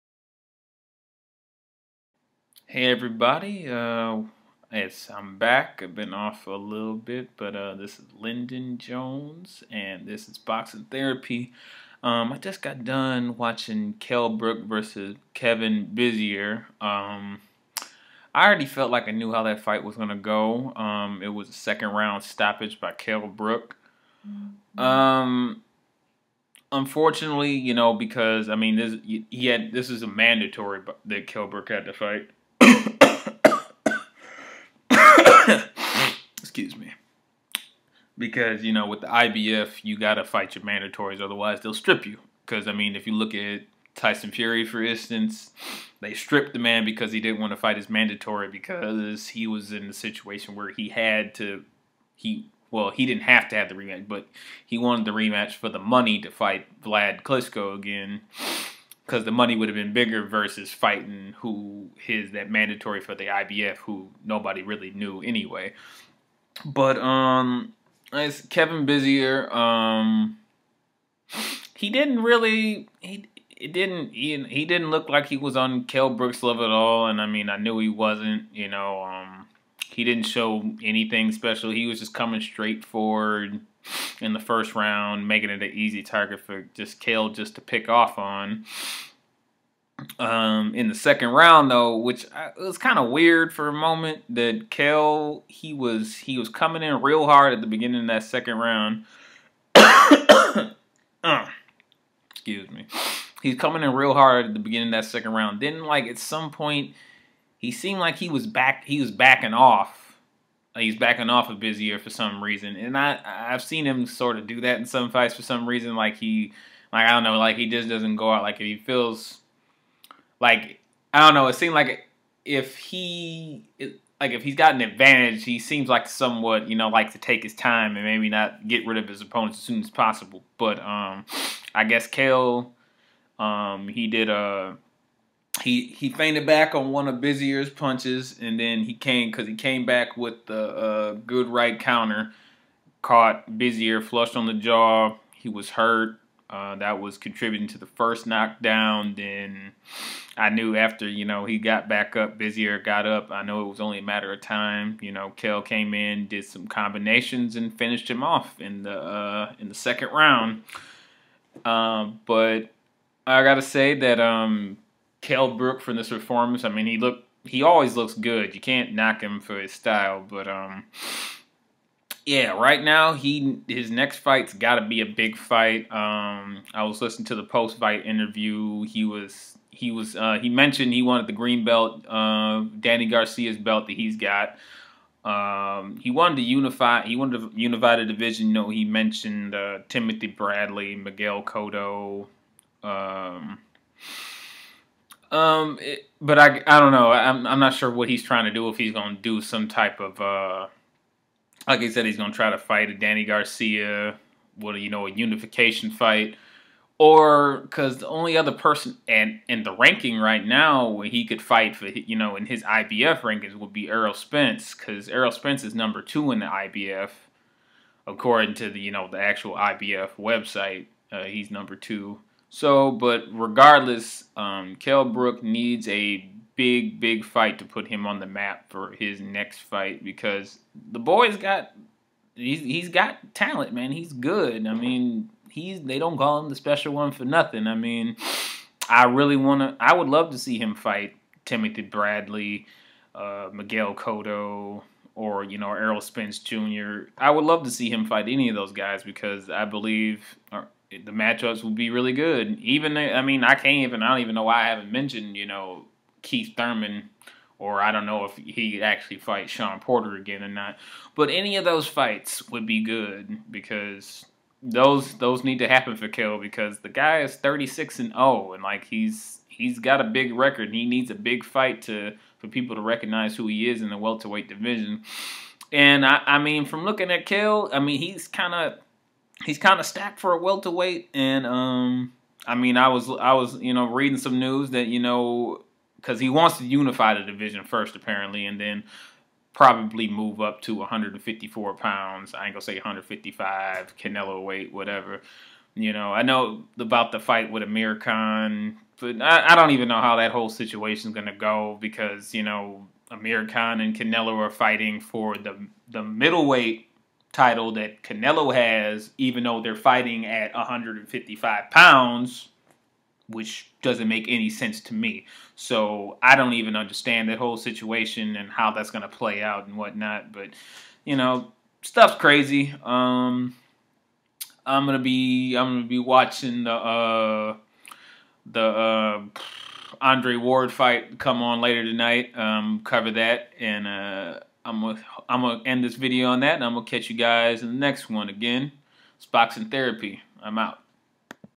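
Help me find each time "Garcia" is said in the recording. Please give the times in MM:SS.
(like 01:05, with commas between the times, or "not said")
03:03, 03:23.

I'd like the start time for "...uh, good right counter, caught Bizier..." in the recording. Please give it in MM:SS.
02:20.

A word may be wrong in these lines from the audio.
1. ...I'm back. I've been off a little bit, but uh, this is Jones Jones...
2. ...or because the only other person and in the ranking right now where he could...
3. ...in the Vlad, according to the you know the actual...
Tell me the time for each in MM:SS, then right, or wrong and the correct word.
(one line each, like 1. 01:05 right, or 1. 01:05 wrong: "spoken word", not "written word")
1. 00:05 wrong: "Lyndon", not "Jones"
2. 03:26 right
3. 03:36 wrong: "IBF", not "Vlad".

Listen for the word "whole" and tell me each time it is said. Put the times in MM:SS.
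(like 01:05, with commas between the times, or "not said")
05:00, 05:17.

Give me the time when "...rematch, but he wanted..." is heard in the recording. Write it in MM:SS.
00:53.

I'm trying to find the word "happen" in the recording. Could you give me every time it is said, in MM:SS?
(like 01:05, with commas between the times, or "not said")
04:25.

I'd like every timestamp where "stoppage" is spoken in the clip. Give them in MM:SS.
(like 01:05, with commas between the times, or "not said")
00:22.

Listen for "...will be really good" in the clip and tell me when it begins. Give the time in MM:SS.
04:11.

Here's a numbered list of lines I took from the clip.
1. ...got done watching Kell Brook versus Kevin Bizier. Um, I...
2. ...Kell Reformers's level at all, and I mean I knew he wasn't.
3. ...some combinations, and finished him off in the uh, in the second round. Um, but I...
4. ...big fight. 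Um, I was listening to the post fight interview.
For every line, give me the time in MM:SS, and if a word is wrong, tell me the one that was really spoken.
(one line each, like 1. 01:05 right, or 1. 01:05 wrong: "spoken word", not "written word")
1. 00:12 right
2. 01:15 wrong: "Brook", not "Reformers"
3. 02:36 right
4. 02:55 right.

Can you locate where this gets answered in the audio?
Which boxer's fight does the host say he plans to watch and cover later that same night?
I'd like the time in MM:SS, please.
05:29.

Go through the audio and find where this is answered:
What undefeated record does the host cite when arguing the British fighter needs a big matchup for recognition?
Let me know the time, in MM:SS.
04:27.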